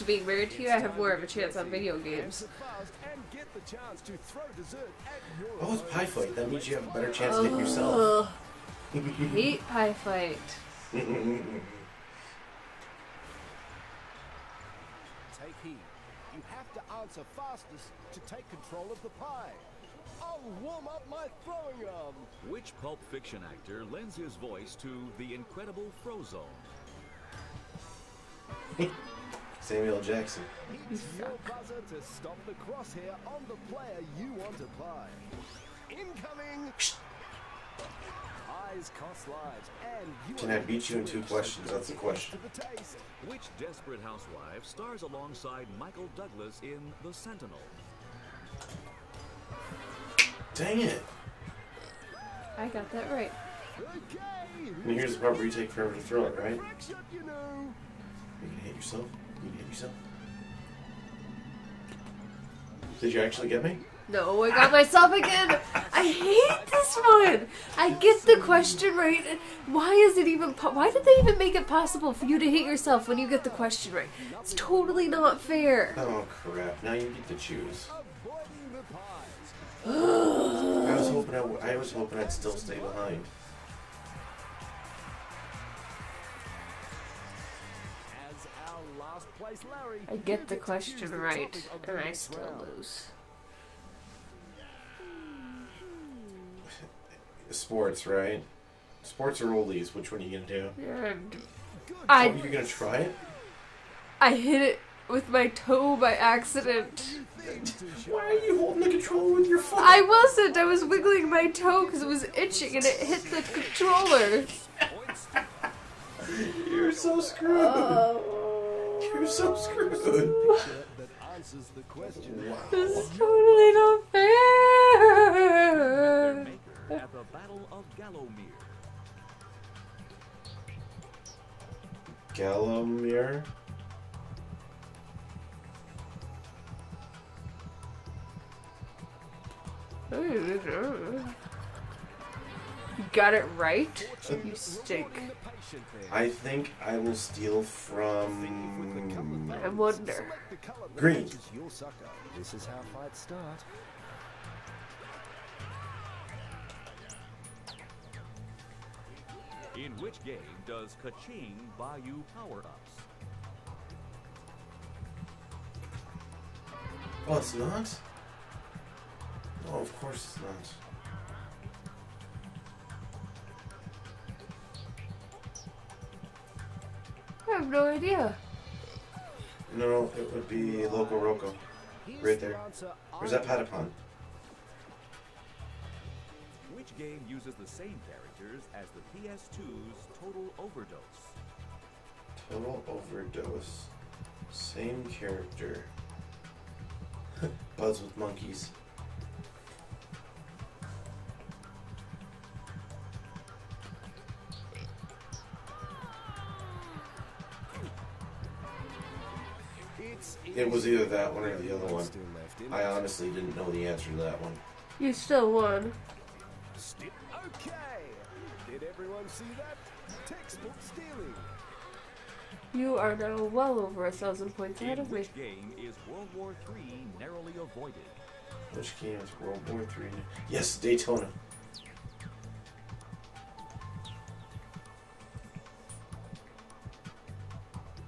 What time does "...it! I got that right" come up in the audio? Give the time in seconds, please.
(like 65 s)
50 s.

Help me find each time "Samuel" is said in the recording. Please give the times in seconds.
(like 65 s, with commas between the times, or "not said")
29 s.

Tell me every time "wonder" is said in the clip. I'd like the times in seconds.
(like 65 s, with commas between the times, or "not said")
149 s.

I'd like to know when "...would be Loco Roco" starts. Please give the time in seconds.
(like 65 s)
180 s.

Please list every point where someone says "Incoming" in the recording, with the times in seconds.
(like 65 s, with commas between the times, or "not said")
35 s.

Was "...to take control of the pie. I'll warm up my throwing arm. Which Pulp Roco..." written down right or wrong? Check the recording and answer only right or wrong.
wrong.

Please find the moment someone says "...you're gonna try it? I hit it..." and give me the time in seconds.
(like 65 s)
102 s.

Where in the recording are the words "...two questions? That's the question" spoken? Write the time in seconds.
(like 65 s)
41 s.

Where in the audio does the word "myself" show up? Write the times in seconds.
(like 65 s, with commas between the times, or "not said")
64 s.